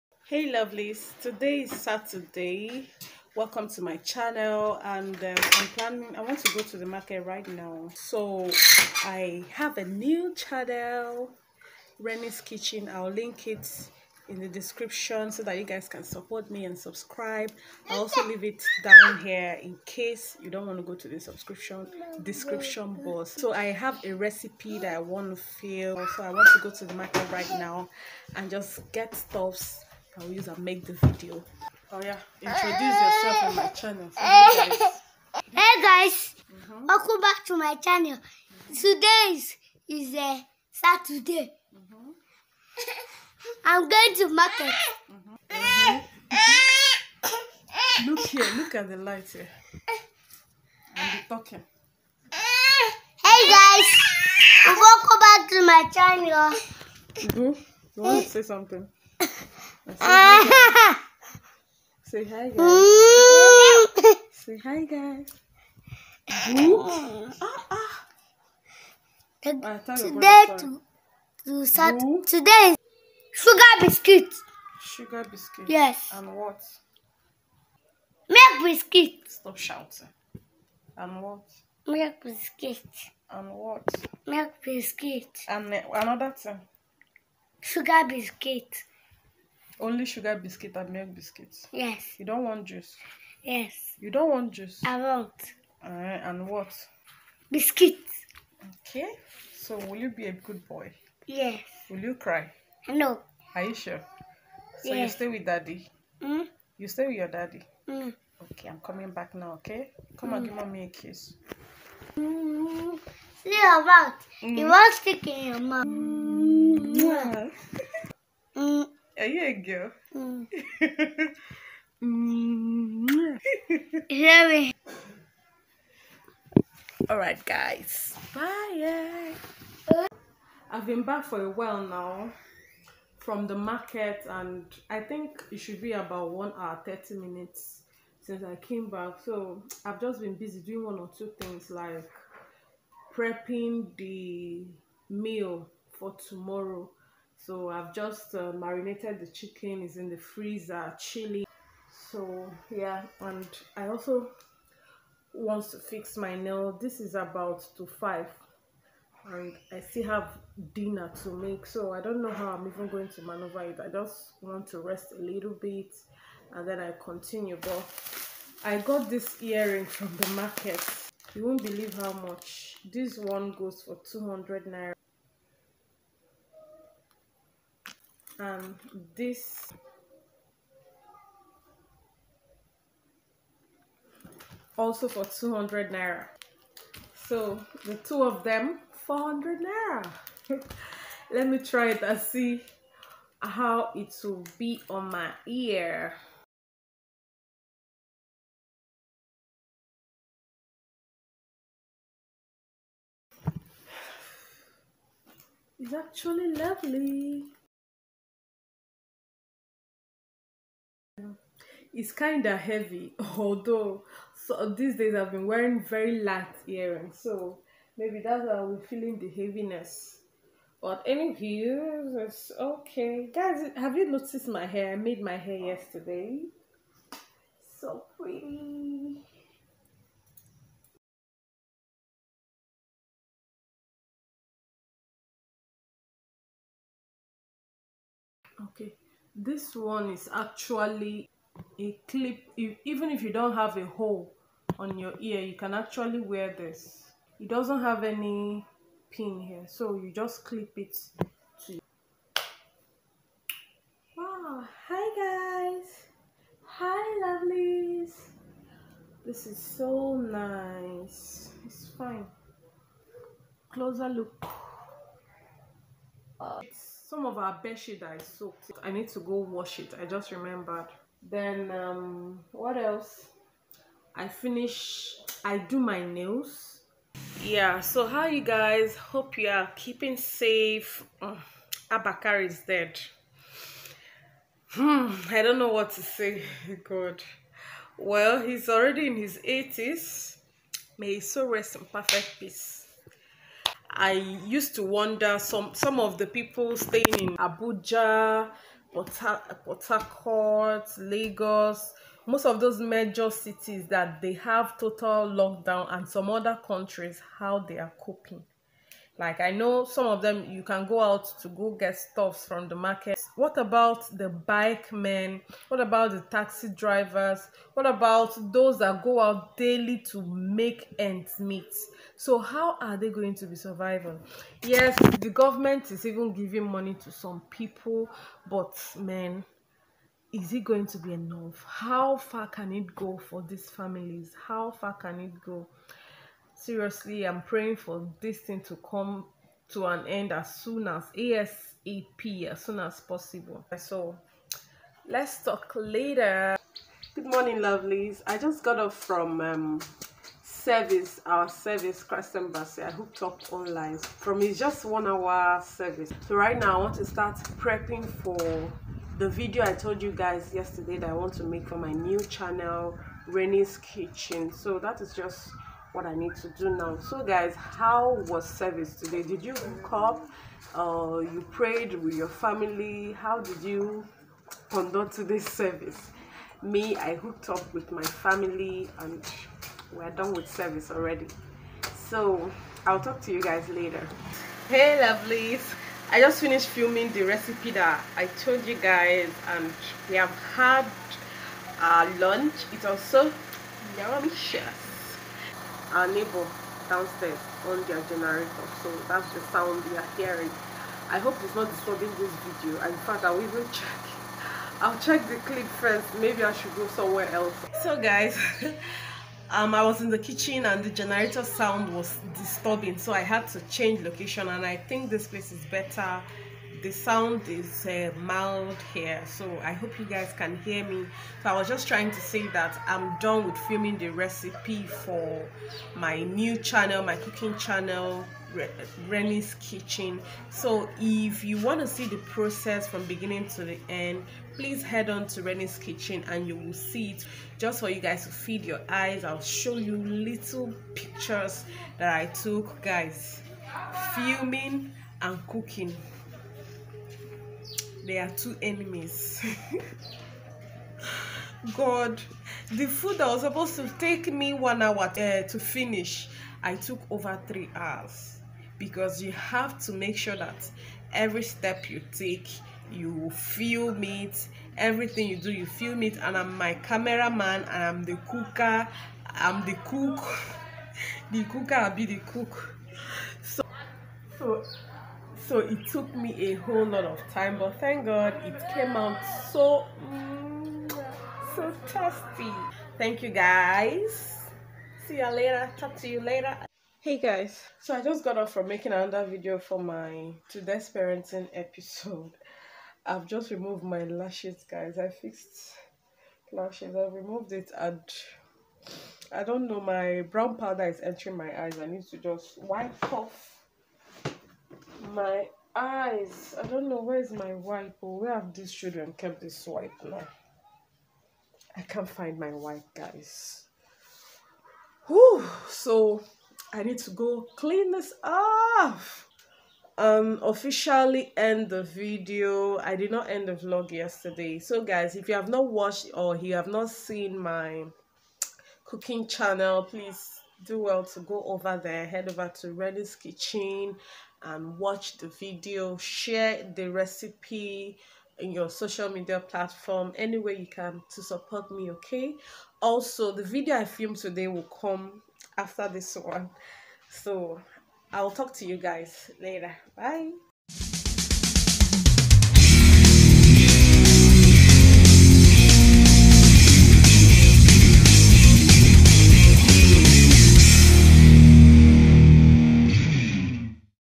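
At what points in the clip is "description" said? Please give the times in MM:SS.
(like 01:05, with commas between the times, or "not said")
00:14, 00:22.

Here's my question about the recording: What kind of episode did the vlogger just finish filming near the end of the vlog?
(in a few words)
Parenting episode.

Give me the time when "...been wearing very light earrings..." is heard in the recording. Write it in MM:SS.
03:35.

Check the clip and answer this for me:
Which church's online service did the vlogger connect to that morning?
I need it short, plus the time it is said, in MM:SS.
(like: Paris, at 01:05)
Christ Embassy, at 05:52.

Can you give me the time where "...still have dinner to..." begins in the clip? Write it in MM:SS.
02:39.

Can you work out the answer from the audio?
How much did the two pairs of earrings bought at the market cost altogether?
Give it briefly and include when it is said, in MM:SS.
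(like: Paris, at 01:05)
400 naira, at 03:08.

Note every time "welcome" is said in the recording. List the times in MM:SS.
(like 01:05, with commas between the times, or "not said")
00:03, 00:36, 00:54.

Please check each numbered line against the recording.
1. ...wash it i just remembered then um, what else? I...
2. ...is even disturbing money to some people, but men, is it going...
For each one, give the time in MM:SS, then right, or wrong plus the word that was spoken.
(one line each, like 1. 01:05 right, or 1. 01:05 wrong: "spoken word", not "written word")
1. 04:29 right
2. 05:25 wrong: "giving", not "disturbing".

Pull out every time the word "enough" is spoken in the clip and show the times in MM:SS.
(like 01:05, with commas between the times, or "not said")
05:31.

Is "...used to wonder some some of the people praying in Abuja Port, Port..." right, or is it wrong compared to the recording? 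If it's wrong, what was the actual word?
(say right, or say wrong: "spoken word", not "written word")
wrong: "staying", not "praying".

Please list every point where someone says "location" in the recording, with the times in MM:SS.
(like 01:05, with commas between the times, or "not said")
06:54.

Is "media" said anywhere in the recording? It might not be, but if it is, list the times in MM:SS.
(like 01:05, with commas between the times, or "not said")
08:59.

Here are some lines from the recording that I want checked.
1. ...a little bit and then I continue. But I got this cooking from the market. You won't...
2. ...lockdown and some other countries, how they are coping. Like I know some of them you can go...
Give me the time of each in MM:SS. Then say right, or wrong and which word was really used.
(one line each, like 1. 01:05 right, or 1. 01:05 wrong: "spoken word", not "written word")
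1. 02:45 wrong: "earring", not "cooking"
2. 05:05 right.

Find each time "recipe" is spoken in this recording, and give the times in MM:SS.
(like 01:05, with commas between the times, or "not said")
00:24, 06:27, 07:04, 08:56.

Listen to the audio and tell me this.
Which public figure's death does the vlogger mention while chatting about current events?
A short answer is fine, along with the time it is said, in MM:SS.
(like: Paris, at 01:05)
Abba Kyari, at 04:41.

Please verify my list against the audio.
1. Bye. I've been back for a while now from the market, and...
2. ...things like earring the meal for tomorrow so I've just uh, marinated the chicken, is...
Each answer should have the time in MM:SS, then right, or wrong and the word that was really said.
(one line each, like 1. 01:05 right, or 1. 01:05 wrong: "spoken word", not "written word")
1. 02:08 right
2. 02:21 wrong: "prepping", not "earring".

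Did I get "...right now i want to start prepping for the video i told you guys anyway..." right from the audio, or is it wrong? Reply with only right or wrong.
wrong.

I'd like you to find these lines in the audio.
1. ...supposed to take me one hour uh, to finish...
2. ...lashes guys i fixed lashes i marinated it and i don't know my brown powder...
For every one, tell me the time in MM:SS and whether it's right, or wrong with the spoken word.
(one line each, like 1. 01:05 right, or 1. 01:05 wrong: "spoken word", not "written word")
1. 07:33 right
2. 08:14 wrong: "removed", not "marinated".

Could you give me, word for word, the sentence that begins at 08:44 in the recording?
So guys, if you have not watched or you have not seen my cooking channel, please do well to go over there.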